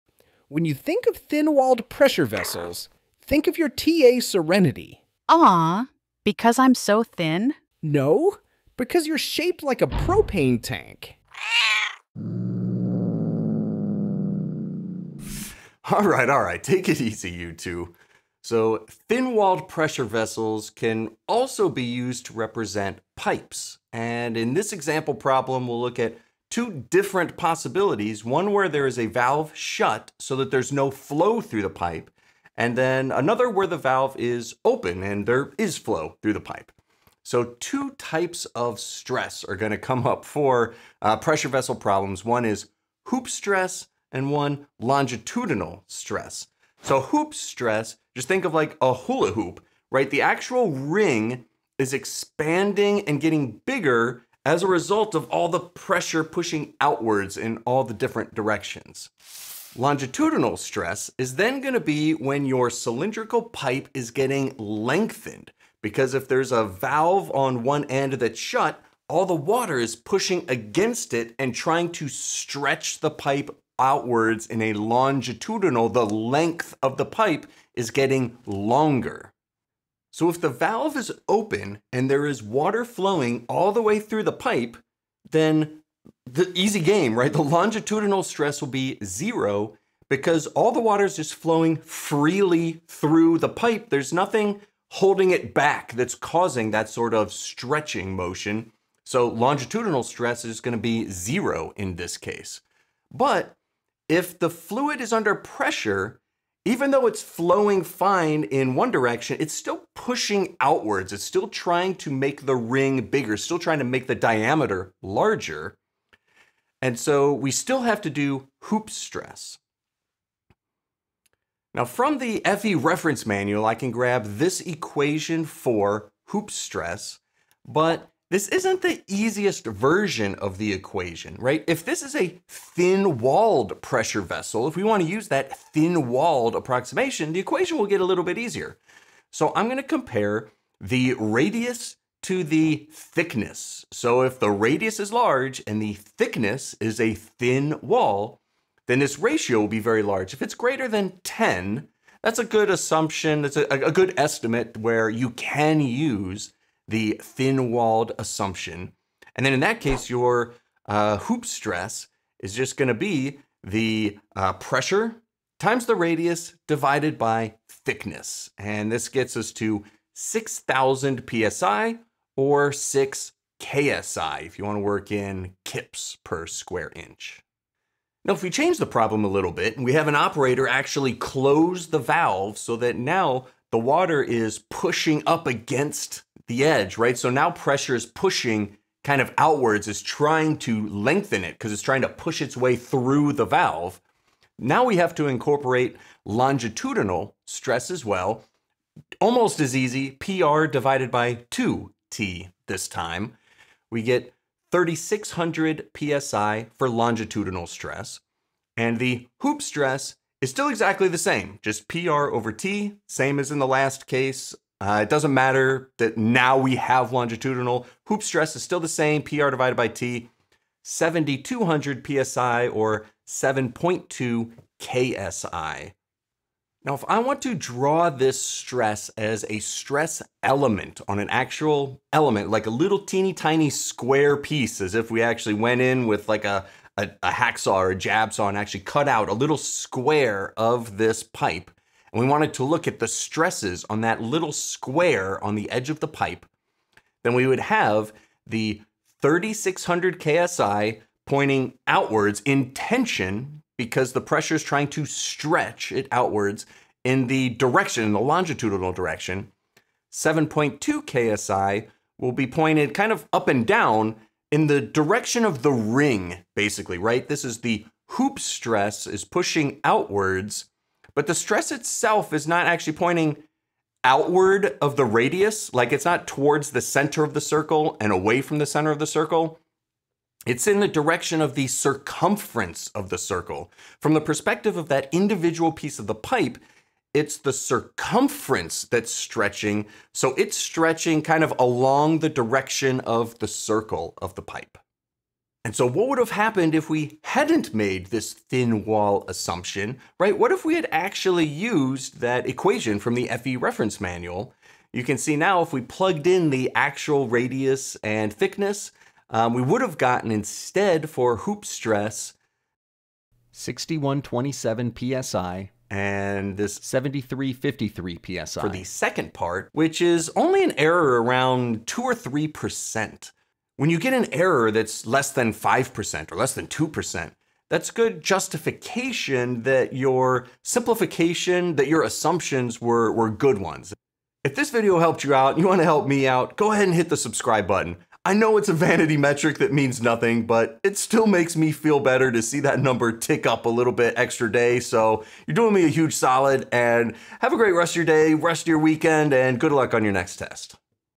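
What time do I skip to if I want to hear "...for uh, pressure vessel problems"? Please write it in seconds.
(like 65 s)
40 s.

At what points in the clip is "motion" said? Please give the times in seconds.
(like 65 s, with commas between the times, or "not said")
98 s.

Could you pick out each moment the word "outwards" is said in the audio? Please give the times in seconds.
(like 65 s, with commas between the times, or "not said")
56 s, 73 s, 110 s, 189 s, 251 s, 256 s, 269 s, 274 s.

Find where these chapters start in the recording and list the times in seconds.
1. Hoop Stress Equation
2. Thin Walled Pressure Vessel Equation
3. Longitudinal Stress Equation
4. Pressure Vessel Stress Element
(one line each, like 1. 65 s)
1. 120 s
2. 159 s
3. 194 s
4. 226 s.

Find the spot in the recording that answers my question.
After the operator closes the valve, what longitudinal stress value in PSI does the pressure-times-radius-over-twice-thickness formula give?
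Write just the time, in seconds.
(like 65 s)
204 s.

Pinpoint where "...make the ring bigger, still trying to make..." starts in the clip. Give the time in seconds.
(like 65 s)
112 s.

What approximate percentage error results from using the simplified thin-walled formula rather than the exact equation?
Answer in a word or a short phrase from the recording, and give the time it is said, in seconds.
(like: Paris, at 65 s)
2 or 3%, at 321 s.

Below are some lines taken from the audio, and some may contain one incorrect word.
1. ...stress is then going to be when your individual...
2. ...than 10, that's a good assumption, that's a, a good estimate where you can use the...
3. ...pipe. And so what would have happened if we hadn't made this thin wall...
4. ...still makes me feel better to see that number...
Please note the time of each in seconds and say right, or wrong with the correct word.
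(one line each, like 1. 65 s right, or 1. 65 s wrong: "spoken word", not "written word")
1. 60 s wrong: "cylindrical", not "individual"
2. 150 s right
3. 294 s right
4. 340 s right.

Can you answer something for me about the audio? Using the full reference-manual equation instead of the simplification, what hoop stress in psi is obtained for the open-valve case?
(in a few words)
6127 psi.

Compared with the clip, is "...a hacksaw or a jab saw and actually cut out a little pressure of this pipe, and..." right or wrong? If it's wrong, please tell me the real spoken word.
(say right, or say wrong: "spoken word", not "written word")
wrong: "square", not "pressure".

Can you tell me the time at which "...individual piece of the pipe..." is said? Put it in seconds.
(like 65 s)
285 s.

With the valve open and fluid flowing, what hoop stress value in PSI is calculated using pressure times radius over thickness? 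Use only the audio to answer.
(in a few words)
6,000 PSI.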